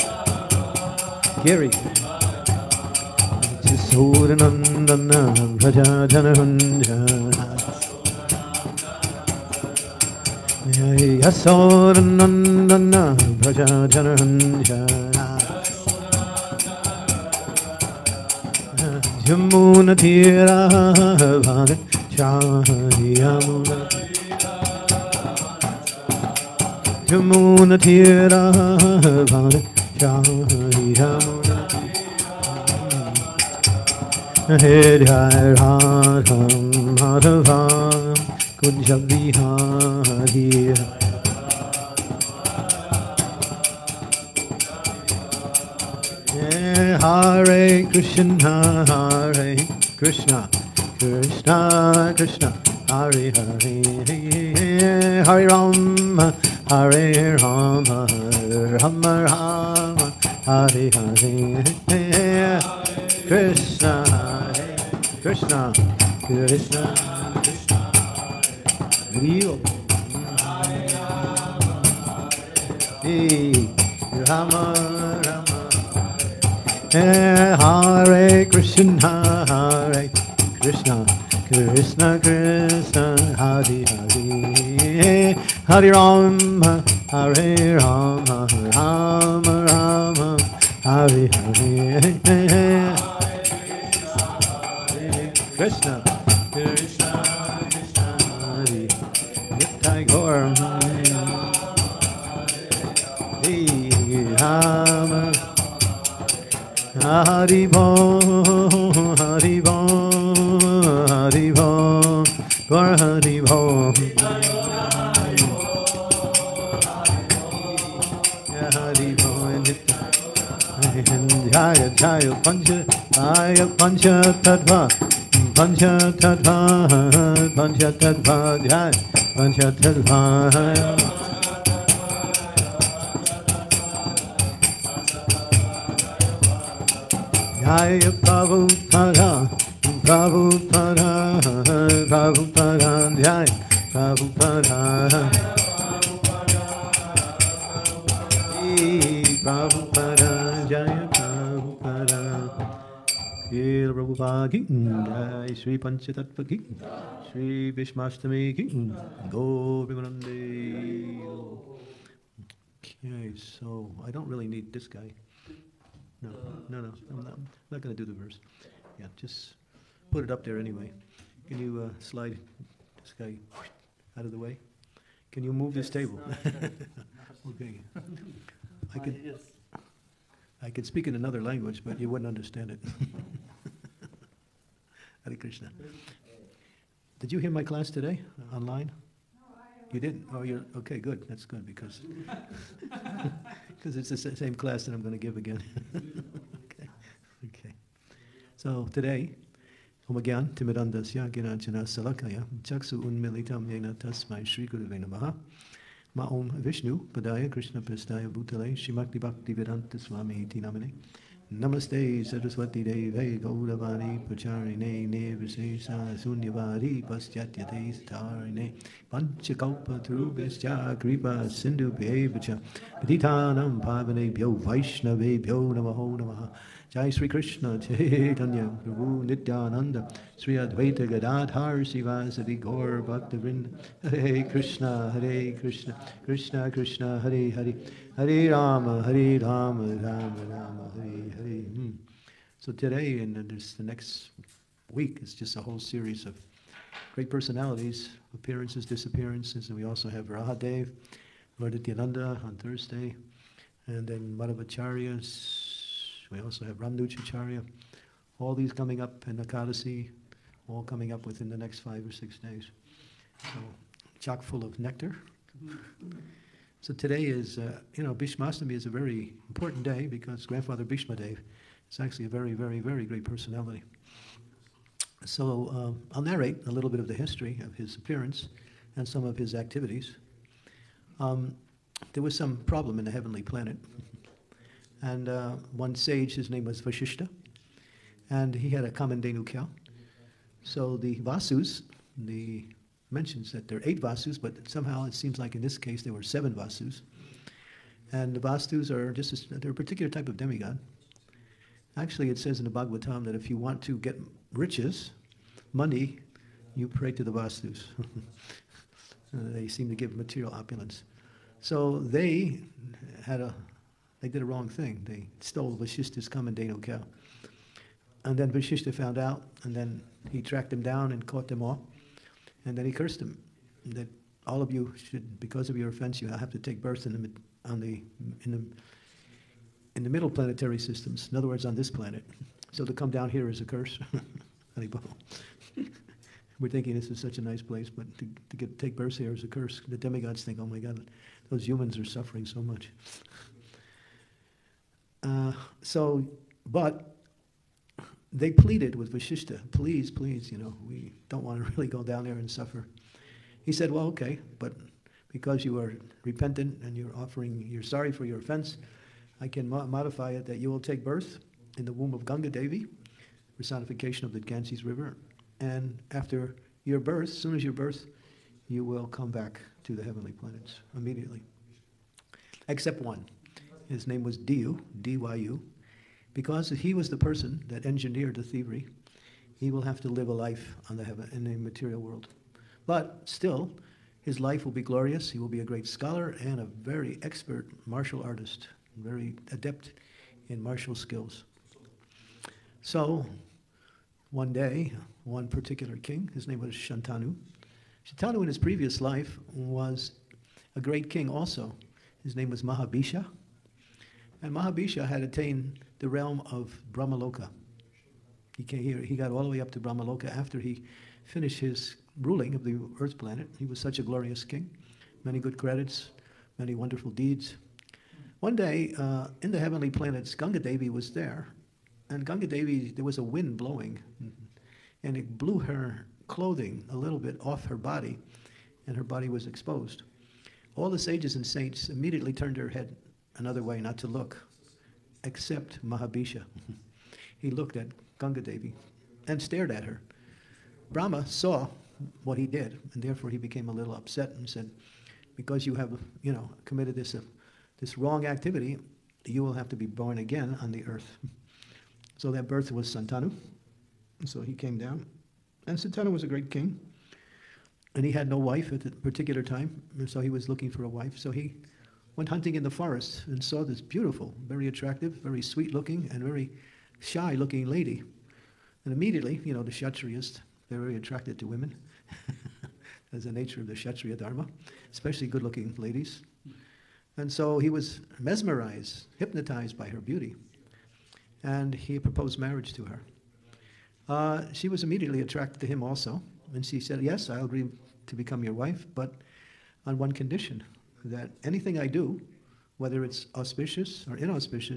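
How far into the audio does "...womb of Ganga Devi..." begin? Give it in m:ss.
6:01.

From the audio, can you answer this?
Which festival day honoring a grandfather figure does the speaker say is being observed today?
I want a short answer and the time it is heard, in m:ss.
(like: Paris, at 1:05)
Bhishmastami, at 4:28.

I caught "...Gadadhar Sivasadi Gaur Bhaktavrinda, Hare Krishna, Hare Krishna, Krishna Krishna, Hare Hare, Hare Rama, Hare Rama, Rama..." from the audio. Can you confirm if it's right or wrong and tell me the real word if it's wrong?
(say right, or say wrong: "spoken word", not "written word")
right.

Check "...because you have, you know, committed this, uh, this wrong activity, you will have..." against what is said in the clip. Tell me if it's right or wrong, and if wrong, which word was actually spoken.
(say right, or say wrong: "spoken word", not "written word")
right.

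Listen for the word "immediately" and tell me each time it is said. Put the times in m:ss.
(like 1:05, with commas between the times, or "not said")
6:10, 7:11, 7:48, 8:04.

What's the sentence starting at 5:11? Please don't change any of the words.
So they had a, they did a wrong thing.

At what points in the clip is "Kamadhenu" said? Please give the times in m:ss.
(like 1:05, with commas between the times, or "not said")
4:48, 5:16.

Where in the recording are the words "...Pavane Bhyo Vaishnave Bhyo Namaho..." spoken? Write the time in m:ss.
3:41.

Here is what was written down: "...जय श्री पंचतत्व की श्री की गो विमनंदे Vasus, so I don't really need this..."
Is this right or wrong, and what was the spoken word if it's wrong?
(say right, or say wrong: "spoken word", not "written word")
wrong: "Okay", not "Vasus".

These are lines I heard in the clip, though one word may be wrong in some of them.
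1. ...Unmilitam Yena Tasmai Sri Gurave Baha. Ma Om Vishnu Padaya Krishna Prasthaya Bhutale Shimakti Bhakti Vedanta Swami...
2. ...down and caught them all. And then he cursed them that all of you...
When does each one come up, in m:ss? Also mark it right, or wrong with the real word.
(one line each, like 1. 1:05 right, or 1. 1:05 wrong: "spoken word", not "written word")
1. 3:23 right
2. 5:20 right.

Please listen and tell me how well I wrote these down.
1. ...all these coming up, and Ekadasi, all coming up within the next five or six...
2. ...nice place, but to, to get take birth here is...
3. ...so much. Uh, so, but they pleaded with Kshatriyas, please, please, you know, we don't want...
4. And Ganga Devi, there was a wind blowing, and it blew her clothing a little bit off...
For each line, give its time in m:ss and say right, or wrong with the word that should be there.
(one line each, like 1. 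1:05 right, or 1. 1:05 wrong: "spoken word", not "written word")
1. 4:18 right
2. 5:37 right
3. 5:42 wrong: "Vashishta", not "Kshatriyas"
4. 7:02 right.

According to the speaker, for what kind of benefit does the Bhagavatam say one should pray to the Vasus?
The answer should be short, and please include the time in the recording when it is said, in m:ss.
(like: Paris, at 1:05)
riches, money, at 5:04.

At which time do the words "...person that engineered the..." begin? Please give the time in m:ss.
6:17.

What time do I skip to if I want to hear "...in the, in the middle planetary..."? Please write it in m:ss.
5:28.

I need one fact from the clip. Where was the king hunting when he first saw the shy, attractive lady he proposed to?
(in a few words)
the forest.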